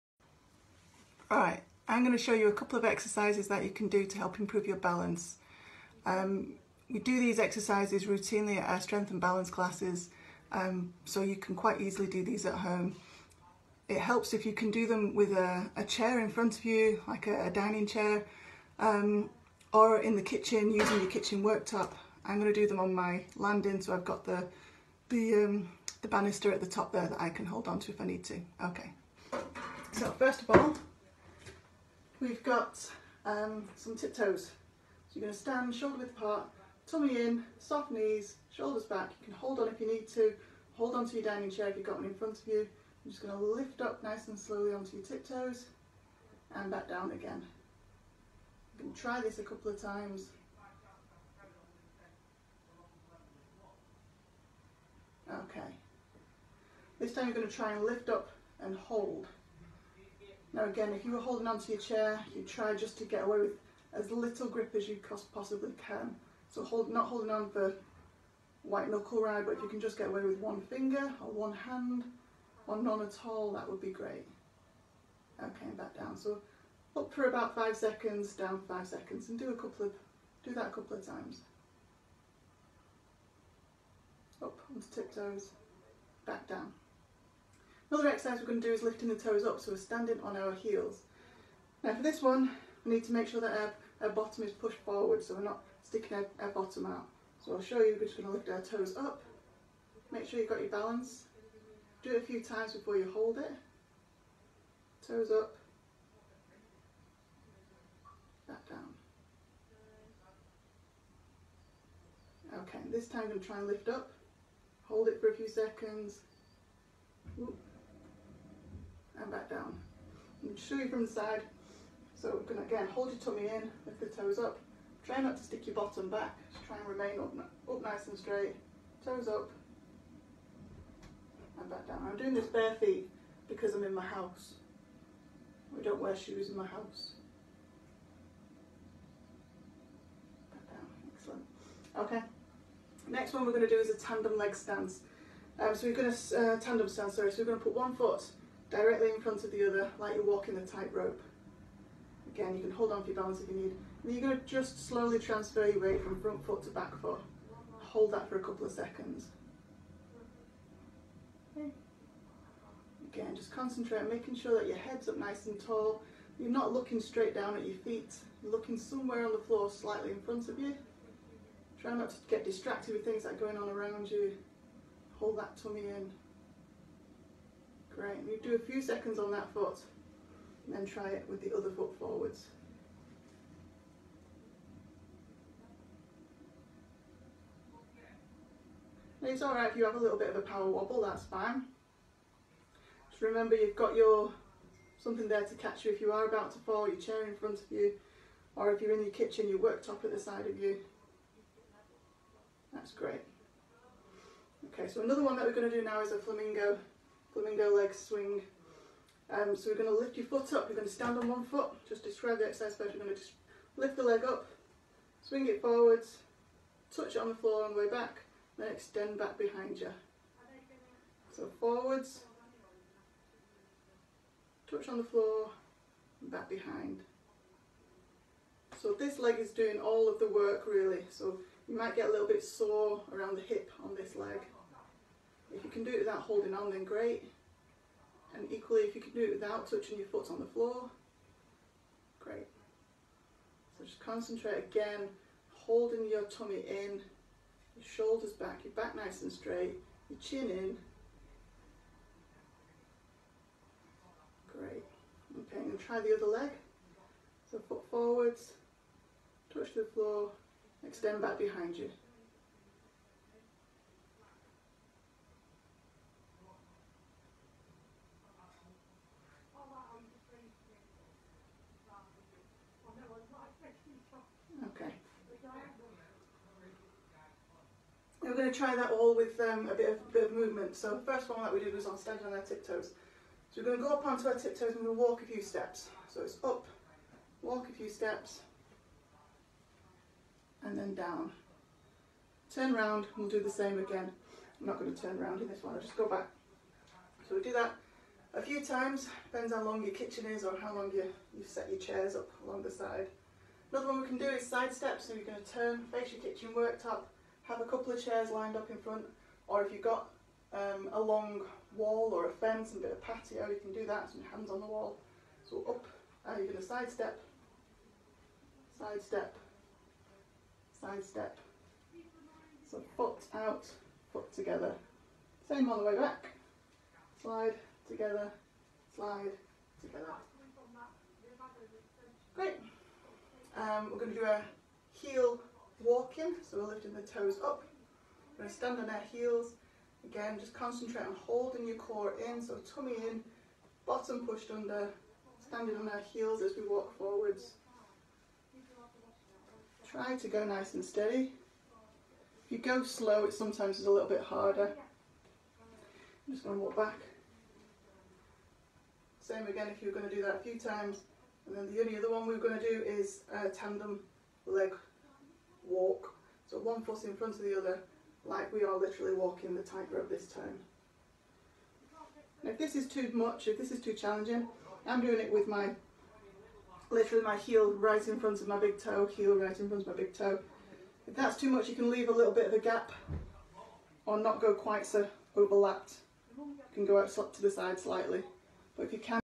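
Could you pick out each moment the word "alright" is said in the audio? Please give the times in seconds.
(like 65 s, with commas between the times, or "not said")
189 s.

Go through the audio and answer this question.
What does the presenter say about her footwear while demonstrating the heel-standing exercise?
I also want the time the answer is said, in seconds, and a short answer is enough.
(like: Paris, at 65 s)
Bare feet, at 132 s.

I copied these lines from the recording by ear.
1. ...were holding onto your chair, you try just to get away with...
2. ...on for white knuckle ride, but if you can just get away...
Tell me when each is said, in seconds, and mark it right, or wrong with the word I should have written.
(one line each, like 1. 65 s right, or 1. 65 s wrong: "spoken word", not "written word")
1. 61 s right
2. 67 s right.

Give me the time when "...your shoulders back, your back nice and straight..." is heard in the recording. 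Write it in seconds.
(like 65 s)
247 s.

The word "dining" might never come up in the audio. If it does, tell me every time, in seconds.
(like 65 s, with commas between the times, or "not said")
17 s, 41 s.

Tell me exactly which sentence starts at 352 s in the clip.
If you go slow, it sometimes is a little bit harder.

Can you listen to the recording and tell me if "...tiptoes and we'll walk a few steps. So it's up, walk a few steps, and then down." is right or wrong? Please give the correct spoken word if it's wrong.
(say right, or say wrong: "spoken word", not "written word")
right.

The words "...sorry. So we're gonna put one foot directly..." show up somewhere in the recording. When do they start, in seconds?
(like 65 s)
147 s.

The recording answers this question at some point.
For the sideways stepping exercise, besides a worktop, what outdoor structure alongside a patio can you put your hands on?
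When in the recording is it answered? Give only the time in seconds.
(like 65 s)
312 s.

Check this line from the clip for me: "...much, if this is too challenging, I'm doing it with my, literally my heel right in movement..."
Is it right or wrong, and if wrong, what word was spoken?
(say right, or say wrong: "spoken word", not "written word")
wrong: "front", not "movement".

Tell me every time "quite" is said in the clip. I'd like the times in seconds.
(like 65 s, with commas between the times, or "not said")
11 s, 384 s.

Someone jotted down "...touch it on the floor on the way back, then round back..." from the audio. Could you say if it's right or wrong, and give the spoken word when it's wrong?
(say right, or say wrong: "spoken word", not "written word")
wrong: "extend", not "round".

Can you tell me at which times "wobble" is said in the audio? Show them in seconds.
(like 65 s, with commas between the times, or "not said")
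190 s.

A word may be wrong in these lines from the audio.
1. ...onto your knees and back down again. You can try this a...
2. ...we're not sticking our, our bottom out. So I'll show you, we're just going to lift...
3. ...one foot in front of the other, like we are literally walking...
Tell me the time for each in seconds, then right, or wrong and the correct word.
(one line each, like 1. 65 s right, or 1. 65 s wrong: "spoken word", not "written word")
1. 44 s wrong: "tiptoes", not "knees"
2. 95 s right
3. 366 s right.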